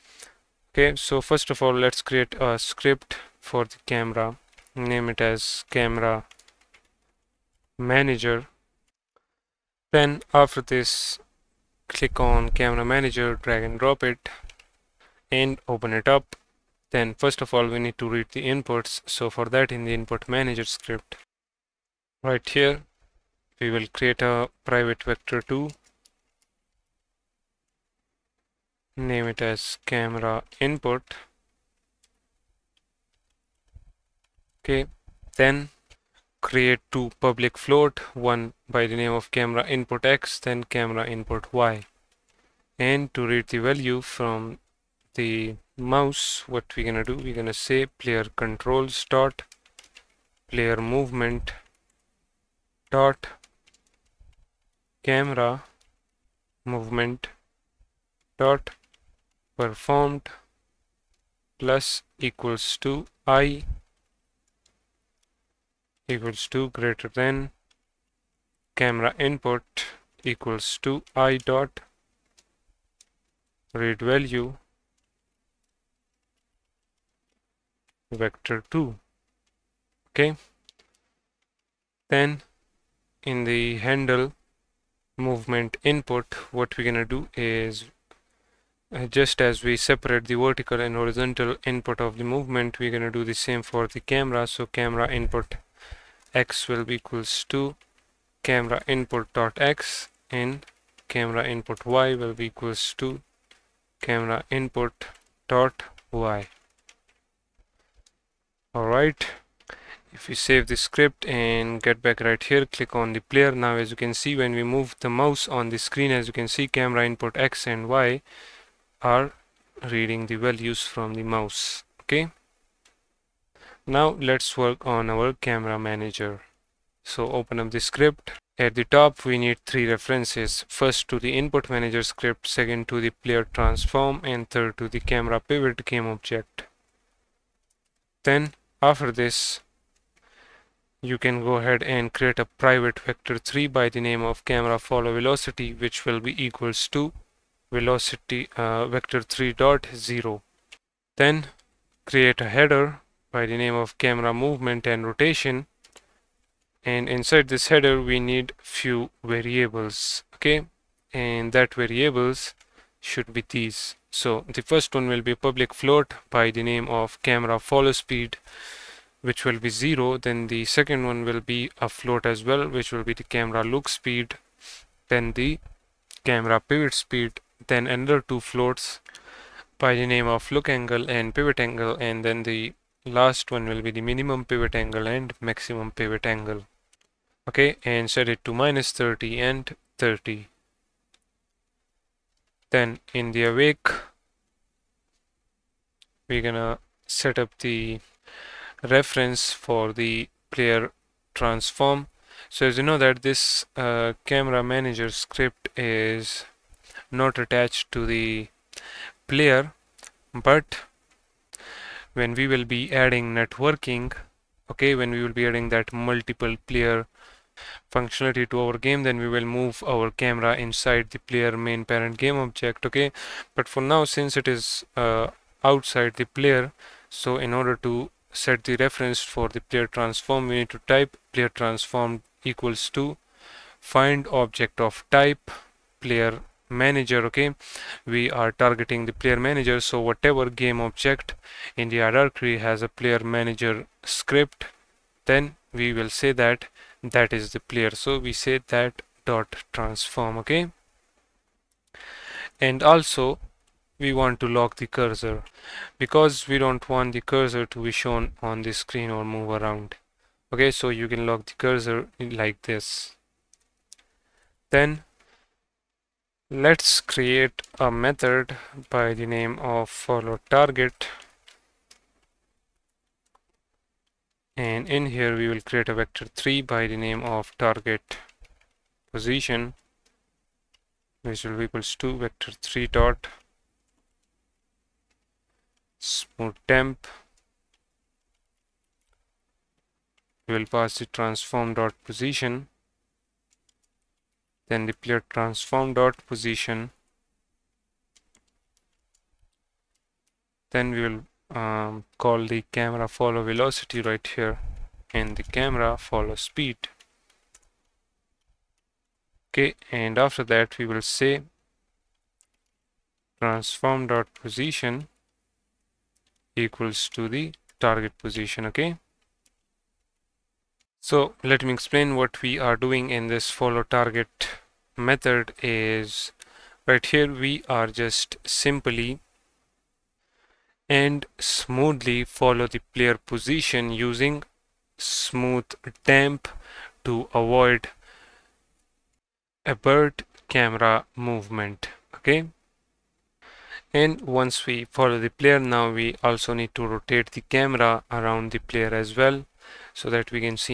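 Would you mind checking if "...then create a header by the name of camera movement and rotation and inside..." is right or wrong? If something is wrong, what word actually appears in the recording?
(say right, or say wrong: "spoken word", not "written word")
right.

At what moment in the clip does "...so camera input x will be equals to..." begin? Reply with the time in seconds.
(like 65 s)
94 s.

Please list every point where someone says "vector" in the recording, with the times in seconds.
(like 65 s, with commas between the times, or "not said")
25 s, 78 s, 142 s, 148 s, 275 s, 282 s.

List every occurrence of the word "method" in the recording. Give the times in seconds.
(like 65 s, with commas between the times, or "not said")
267 s, 324 s.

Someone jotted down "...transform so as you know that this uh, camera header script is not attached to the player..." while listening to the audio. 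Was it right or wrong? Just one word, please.
wrong.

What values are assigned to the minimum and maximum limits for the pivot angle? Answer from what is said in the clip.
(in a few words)
-30 and 30.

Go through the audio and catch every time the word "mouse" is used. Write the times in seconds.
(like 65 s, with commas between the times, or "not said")
45 s, 115 s, 121 s.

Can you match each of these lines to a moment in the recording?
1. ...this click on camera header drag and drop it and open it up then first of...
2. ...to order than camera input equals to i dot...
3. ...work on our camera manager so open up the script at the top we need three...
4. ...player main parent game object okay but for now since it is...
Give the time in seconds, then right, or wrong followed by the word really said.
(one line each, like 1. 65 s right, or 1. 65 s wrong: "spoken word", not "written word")
1. 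10 s wrong: "manager", not "header"
2. 66 s wrong: "greater", not "order"
3. 124 s right
4. 221 s right.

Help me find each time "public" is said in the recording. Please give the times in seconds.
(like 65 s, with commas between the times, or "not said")
37 s, 165 s.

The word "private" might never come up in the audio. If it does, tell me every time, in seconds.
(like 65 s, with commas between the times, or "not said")
24 s, 142 s.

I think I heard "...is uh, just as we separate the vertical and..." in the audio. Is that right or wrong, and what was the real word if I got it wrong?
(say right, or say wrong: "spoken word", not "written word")
right.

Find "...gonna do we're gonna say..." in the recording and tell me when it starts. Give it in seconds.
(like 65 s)
46 s.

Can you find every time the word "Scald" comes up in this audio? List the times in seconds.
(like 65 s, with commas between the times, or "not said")
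not said.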